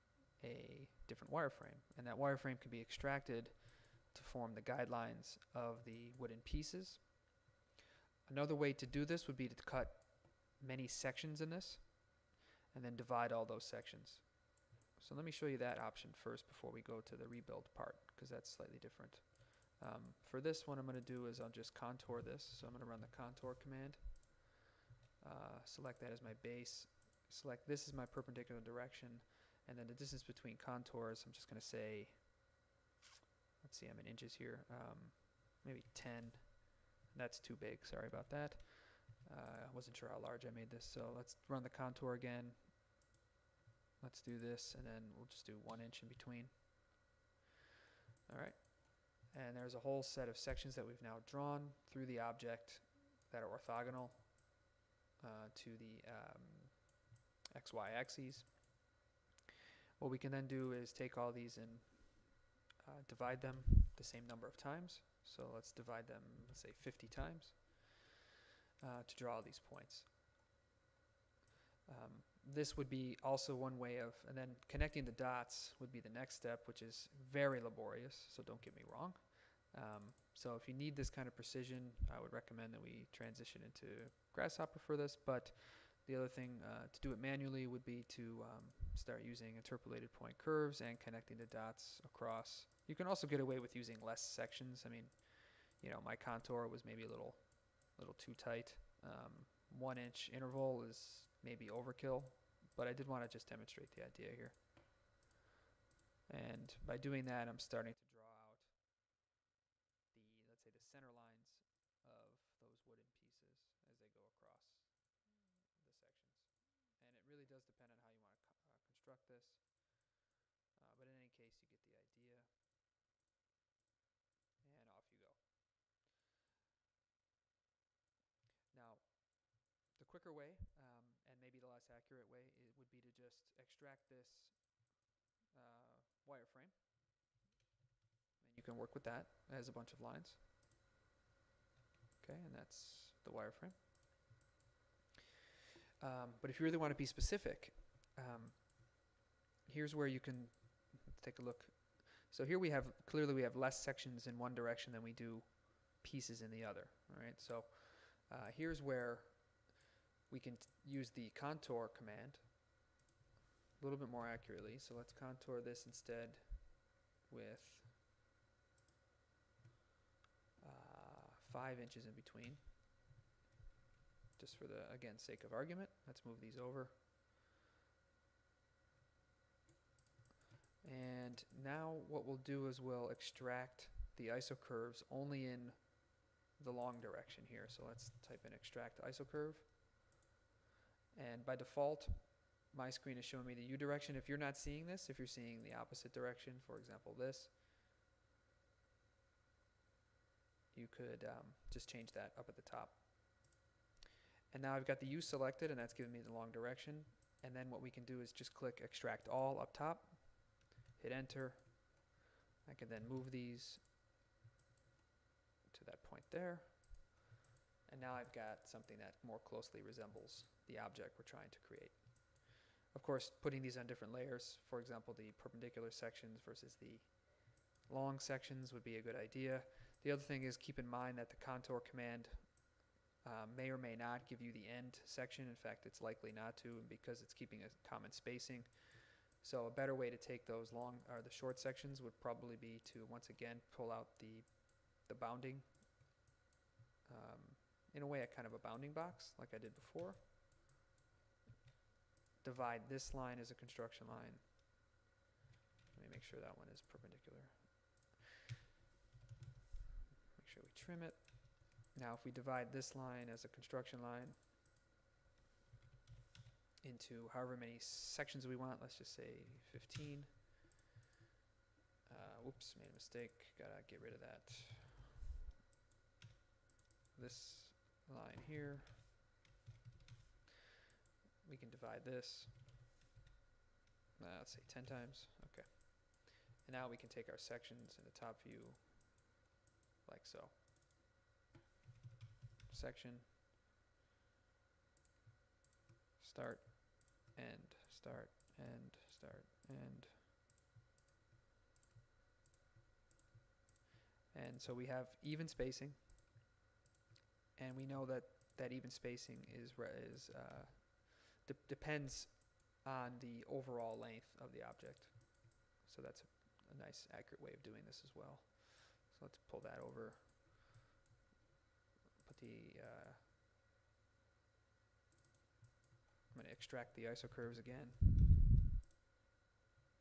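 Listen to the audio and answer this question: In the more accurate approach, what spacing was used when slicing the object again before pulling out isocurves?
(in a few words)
5 inches.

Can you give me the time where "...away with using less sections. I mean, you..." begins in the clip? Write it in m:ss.
1:33.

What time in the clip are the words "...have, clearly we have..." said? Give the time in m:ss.
2:32.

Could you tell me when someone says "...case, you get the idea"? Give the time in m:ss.
2:01.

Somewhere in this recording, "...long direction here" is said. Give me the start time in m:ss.
3:06.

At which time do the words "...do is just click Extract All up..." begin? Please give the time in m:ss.
3:28.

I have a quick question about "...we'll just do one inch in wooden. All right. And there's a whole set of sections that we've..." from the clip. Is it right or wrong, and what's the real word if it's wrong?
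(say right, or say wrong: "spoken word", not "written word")
wrong: "between", not "wooden".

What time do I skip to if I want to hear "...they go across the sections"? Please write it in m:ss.
1:53.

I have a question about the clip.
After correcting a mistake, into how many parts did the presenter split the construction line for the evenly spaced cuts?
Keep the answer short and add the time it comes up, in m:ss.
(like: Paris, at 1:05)
10, at 4:44.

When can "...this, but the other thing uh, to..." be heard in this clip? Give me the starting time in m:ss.
1:24.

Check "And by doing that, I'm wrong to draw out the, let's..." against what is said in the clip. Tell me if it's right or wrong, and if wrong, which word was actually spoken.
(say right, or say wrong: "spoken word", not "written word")
wrong: "starting", not "wrong".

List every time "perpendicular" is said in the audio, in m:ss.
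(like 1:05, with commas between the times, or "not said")
0:28, 3:45, 4:16.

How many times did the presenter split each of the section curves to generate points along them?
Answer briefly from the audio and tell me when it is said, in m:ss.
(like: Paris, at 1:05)
50, at 1:06.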